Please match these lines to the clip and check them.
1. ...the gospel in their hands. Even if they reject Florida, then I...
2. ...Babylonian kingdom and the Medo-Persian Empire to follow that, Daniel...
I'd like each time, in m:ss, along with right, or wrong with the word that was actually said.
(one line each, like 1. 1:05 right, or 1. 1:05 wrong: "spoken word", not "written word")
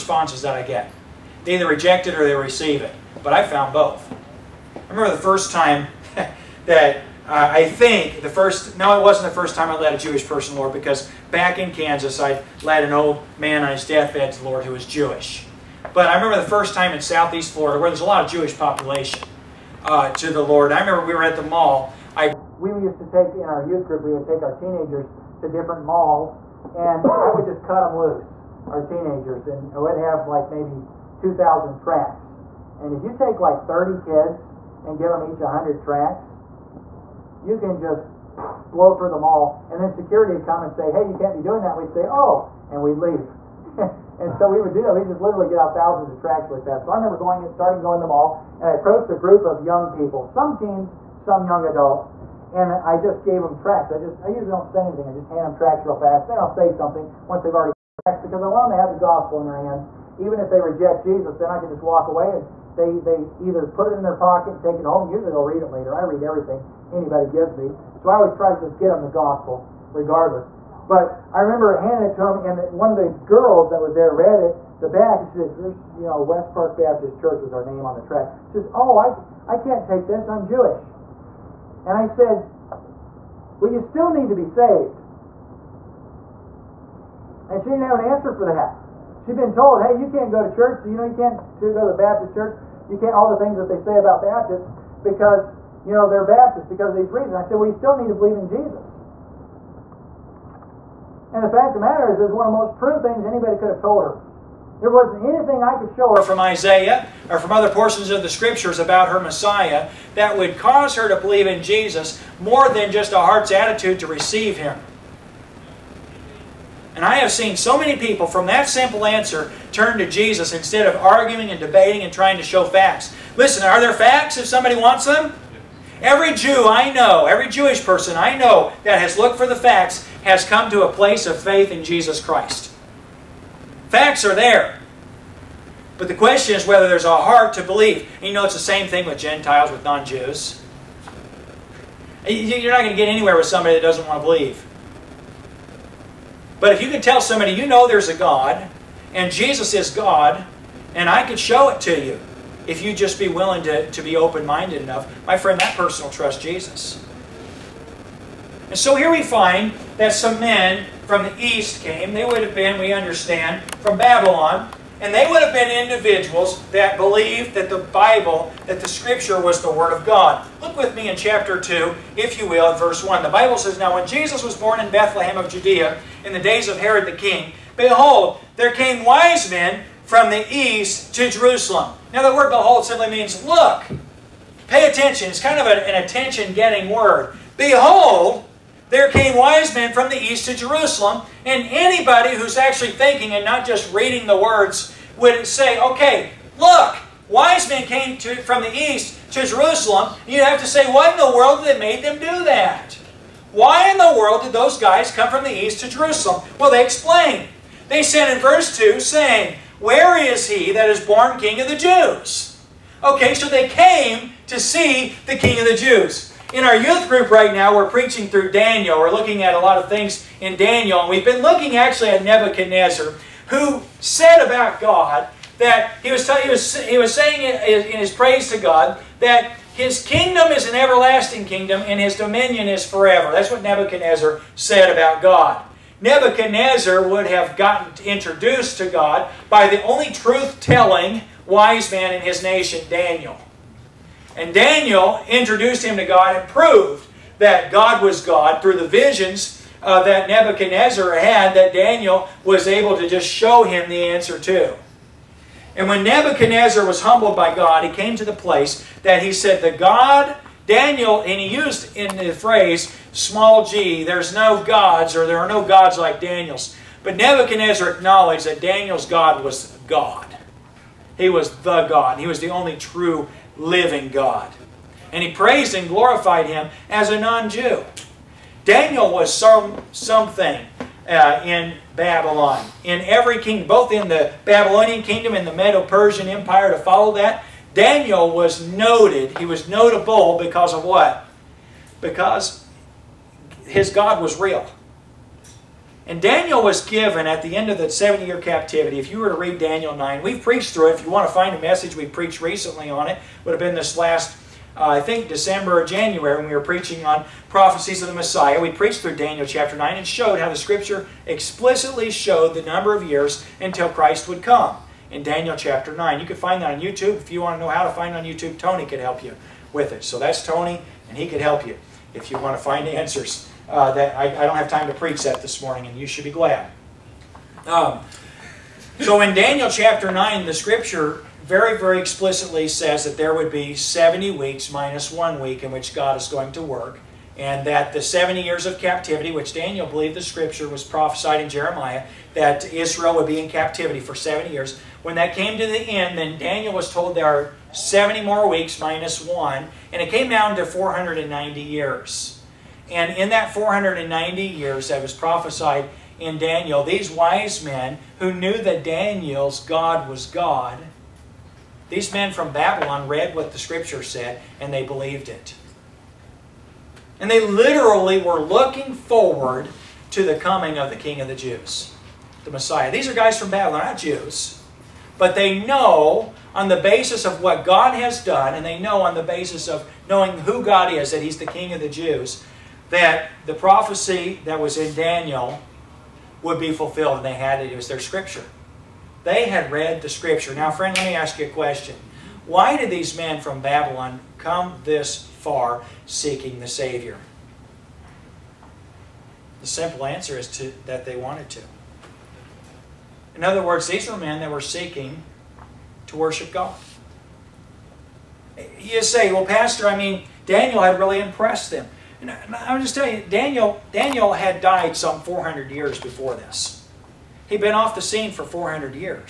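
1. 0:58 wrong: "Jesus", not "Florida"
2. 4:44 right.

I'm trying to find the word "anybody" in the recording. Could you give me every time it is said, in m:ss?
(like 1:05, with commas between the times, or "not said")
1:06, 1:43, 3:11.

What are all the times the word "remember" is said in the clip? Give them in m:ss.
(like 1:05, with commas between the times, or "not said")
0:04, 0:16, 0:20, 0:46, 1:11.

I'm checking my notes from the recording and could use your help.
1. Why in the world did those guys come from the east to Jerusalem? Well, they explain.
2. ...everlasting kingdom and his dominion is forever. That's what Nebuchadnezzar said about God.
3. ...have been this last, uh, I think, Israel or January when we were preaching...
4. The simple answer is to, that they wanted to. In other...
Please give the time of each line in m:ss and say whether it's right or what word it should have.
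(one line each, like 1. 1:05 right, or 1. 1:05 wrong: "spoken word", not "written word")
1. 3:23 right
2. 3:50 right
3. 5:03 wrong: "December", not "Israel"
4. 6:39 right.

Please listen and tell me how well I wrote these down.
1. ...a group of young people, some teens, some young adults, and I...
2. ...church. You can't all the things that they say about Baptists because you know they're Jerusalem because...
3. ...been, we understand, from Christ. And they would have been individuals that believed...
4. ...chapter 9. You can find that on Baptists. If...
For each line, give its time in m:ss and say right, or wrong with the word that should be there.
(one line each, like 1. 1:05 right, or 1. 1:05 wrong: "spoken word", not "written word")
1. 0:49 right
2. 1:32 wrong: "Baptists", not "Jerusalem"
3. 2:42 wrong: "Babylon", not "Christ"
4. 5:15 wrong: "YouTube", not "Baptists".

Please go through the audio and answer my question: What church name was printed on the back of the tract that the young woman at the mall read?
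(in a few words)
West Park Baptist Church.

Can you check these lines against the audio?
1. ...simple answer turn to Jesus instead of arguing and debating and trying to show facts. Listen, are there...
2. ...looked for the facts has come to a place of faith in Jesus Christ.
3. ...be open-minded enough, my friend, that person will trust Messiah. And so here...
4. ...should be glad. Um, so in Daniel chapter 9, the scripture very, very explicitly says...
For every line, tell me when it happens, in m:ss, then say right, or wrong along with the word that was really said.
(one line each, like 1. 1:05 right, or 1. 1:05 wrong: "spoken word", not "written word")
1. 1:58 right
2. 2:09 right
3. 2:34 wrong: "Jesus", not "Messiah"
4. 5:26 right.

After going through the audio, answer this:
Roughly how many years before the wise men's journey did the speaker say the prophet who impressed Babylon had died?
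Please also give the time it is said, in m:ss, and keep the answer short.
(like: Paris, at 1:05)
400, at 6:54.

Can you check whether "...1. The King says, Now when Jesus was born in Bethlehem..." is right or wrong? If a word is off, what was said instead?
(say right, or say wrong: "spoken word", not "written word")
wrong: "Bible", not "King".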